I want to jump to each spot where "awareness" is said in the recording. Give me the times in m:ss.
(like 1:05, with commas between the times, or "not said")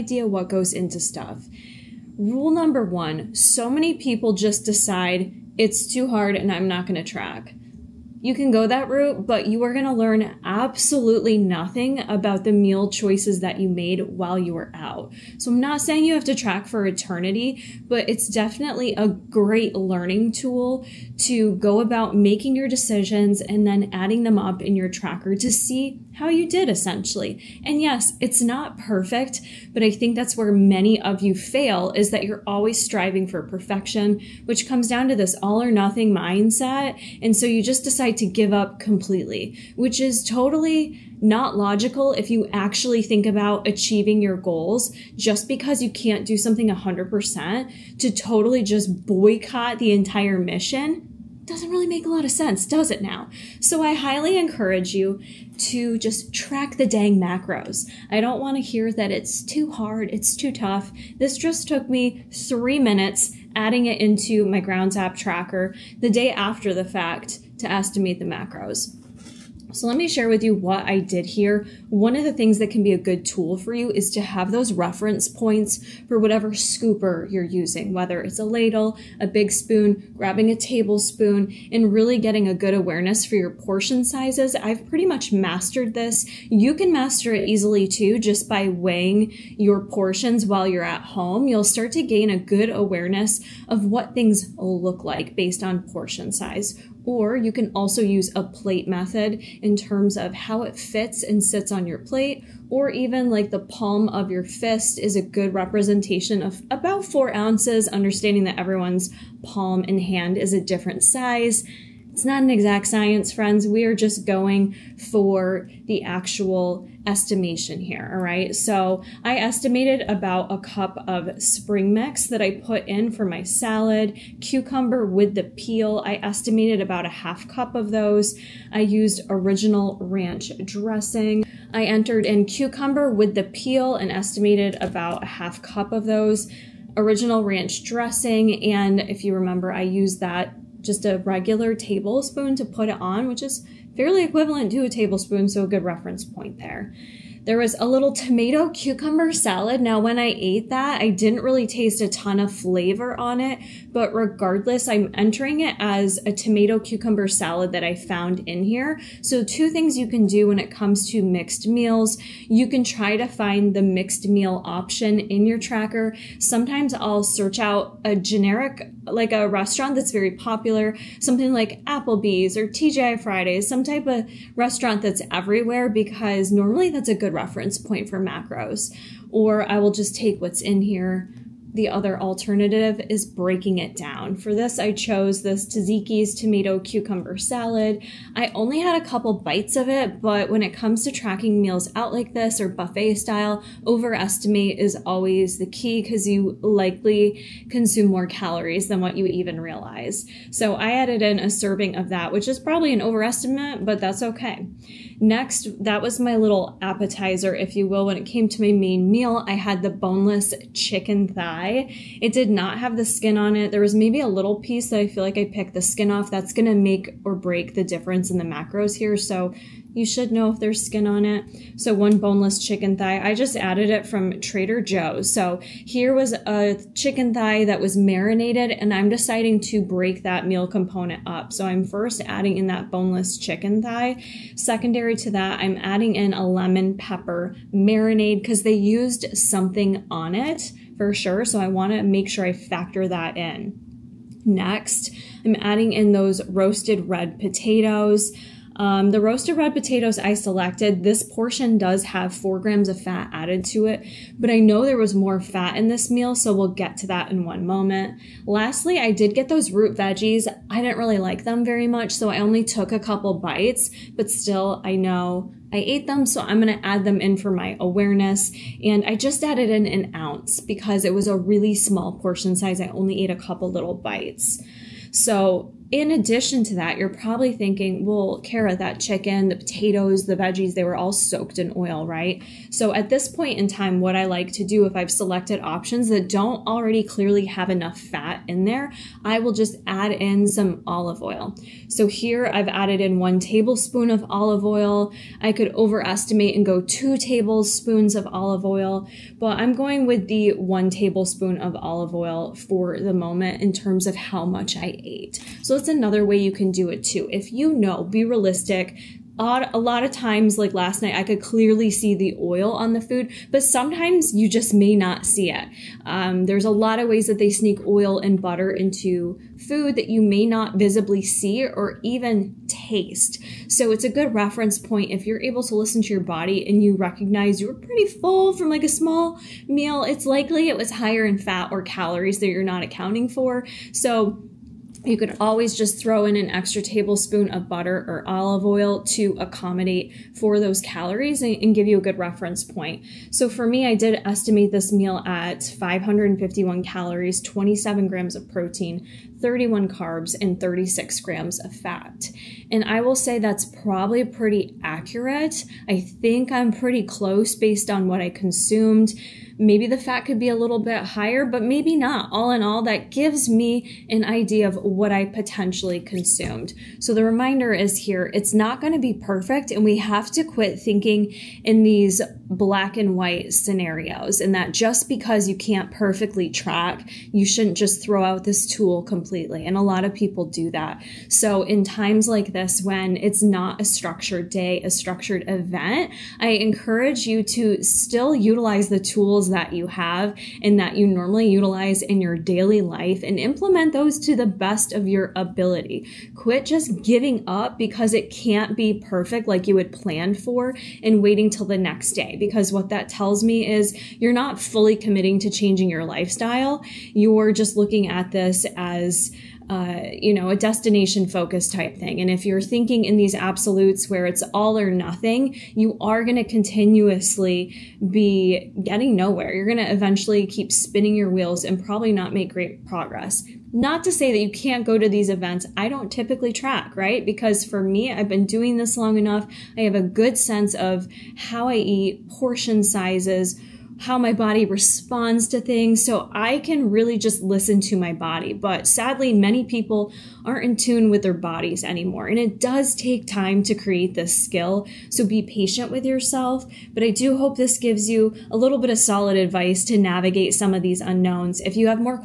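1:22, 1:32, 4:27.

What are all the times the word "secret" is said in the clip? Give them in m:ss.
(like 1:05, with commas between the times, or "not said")
not said.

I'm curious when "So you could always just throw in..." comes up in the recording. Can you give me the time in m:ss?
5:33.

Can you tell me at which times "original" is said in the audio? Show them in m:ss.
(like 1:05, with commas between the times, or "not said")
2:09, 2:16.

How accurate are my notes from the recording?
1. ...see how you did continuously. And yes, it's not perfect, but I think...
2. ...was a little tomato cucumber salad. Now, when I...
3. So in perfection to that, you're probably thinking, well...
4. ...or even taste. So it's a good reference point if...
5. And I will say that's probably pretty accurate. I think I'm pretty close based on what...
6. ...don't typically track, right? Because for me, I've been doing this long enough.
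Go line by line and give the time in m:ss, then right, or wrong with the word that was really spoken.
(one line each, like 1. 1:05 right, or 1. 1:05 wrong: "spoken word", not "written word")
1. 0:25 wrong: "essentially", not "continuously"
2. 2:27 right
3. 4:35 wrong: "addition", not "perfection"
4. 5:21 right
5. 5:52 right
6. 7:05 right.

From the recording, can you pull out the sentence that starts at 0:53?
So I highly encourage you to just track the dang macros.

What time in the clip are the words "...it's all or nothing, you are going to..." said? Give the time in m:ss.
6:54.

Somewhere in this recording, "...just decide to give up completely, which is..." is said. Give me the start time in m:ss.
0:37.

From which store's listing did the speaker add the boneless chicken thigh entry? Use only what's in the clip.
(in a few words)
Trader Joe's.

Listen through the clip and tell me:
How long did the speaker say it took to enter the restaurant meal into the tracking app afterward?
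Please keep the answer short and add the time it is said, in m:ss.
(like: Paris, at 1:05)
3 minutes, at 1:02.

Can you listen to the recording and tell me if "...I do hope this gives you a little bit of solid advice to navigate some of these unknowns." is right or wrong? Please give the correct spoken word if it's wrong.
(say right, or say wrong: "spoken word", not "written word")
right.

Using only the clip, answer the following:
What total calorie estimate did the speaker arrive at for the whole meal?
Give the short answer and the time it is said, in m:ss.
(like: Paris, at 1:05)
551, at 5:45.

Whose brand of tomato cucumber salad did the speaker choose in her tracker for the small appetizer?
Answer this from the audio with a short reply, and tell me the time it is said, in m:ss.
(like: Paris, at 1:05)
Tzatziki's, at 3:05.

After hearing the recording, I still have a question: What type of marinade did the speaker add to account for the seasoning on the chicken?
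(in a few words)
Lemon pepper.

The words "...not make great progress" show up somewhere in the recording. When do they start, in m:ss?
7:02.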